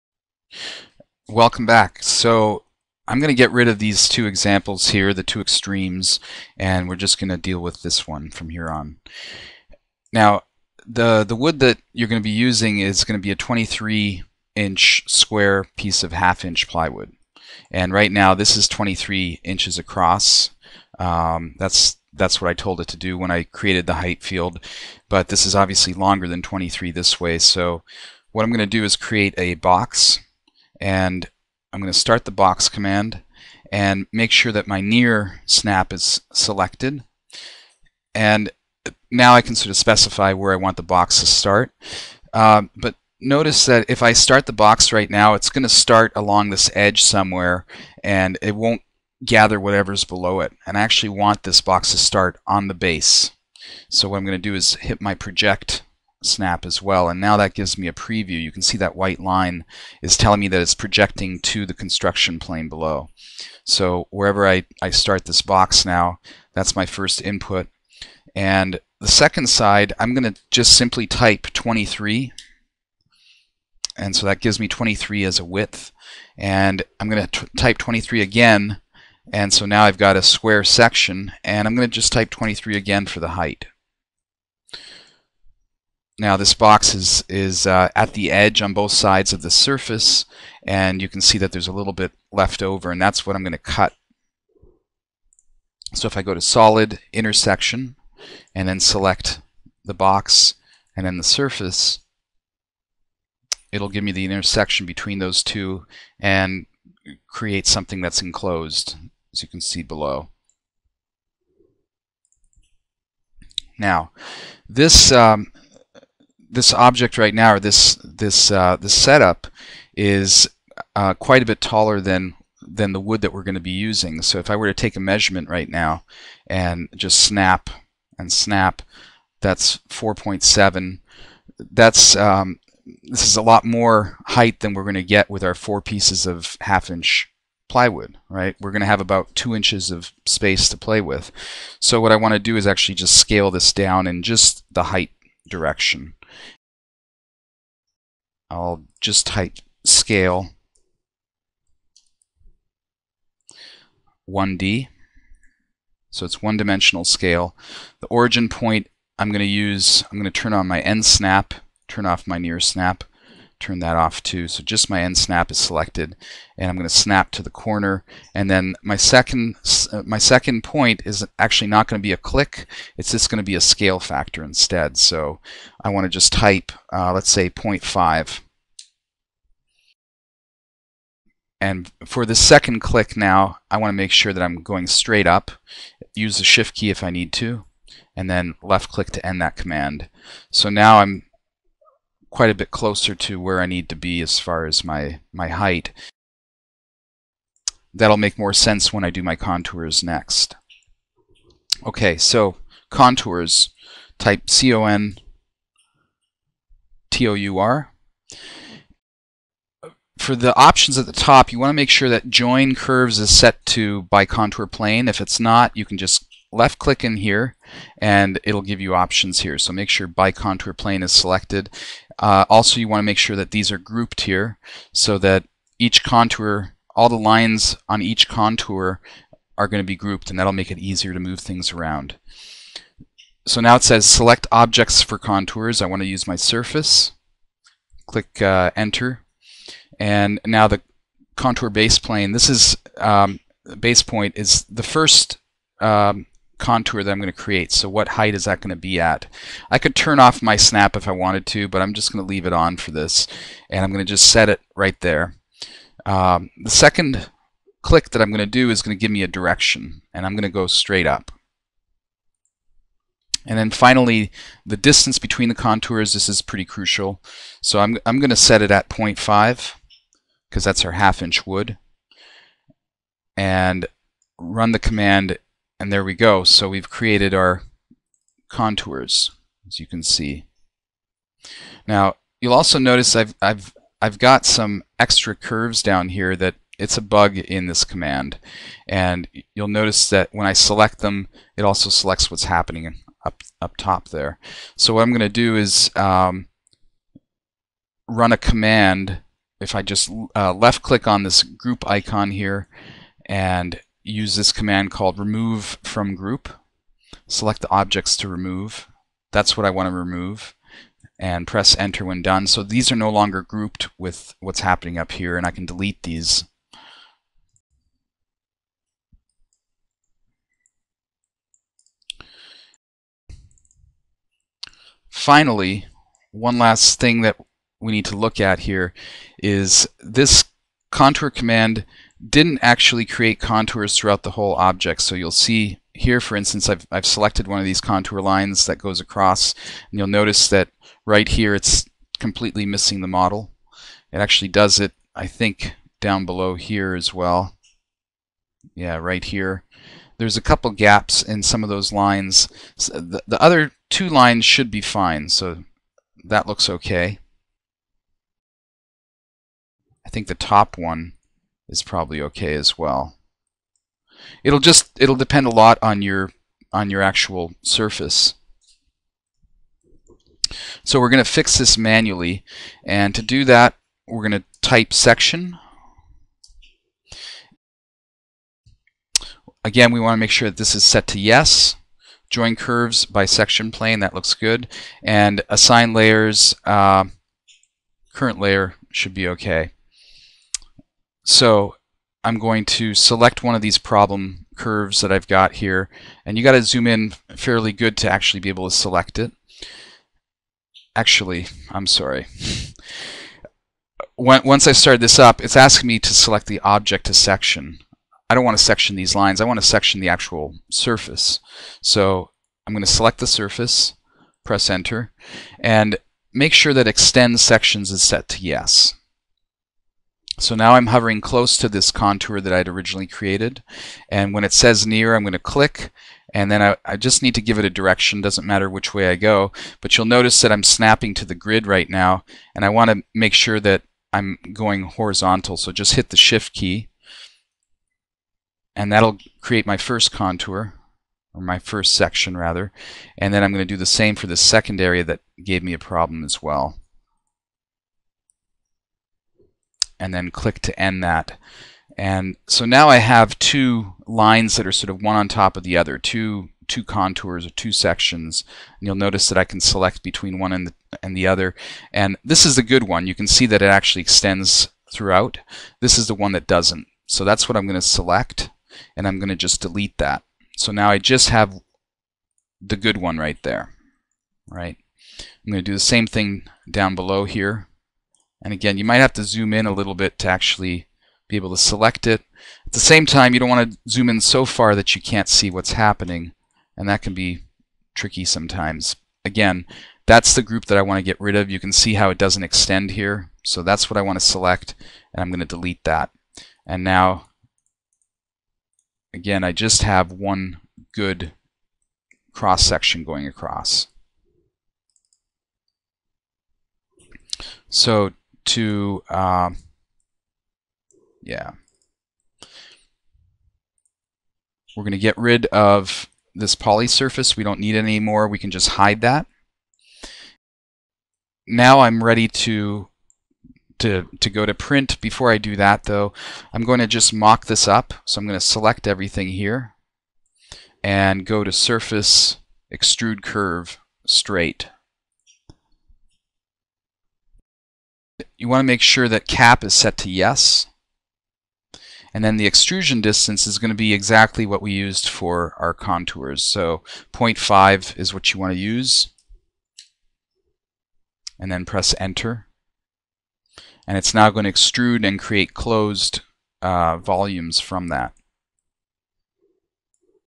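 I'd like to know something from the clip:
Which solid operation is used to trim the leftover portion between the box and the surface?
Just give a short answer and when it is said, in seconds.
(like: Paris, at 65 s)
solid intersection, at 96 s.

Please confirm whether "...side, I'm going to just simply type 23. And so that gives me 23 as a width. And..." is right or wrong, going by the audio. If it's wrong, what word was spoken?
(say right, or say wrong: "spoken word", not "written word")
right.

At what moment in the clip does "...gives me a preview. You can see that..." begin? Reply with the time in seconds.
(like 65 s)
57 s.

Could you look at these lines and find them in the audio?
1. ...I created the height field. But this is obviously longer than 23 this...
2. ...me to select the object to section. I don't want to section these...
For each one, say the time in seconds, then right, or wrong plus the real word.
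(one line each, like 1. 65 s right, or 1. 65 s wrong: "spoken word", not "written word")
1. 23 s right
2. 405 s right.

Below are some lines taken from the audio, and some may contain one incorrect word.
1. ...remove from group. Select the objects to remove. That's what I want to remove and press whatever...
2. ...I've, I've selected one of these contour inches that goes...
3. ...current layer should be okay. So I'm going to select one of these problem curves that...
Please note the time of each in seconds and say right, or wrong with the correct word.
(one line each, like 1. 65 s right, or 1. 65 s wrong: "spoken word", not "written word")
1. 305 s wrong: "enter", not "whatever"
2. 336 s wrong: "lines", not "inches"
3. 388 s right.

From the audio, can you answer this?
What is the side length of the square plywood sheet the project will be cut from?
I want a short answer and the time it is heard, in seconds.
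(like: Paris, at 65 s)
23 inch, at 13 s.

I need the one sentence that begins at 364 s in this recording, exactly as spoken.
It'll just it'll depend a lot on your on your actual surface.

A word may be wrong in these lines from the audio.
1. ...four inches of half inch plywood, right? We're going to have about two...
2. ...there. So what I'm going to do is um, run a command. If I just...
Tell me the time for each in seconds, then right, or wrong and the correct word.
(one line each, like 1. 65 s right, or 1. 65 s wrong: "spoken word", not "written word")
1. 135 s wrong: "pieces", not "inches"
2. 294 s right.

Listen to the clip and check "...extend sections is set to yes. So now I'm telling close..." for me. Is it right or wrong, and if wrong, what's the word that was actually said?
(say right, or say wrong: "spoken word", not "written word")
wrong: "hovering", not "telling".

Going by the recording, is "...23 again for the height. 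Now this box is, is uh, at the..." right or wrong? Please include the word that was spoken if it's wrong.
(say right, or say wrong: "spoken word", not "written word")
right.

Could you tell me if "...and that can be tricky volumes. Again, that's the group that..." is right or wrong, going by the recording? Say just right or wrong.
wrong.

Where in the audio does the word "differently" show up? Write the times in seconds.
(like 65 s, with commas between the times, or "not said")
not said.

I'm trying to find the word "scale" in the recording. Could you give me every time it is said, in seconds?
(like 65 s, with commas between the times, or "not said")
143 s, 149 s, 157 s, 173 s.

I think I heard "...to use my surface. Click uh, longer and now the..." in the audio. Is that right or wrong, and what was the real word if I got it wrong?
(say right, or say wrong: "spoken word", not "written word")
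wrong: "enter", not "longer".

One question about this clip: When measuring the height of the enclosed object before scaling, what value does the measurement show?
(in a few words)
4.7.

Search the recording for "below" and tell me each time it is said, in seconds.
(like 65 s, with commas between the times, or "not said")
50 s, 62 s, 109 s, 346 s, 476 s.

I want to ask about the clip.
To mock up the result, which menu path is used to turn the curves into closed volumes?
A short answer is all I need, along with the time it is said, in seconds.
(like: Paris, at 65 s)
Surface, Extrude Curve, Straight, at 531 s.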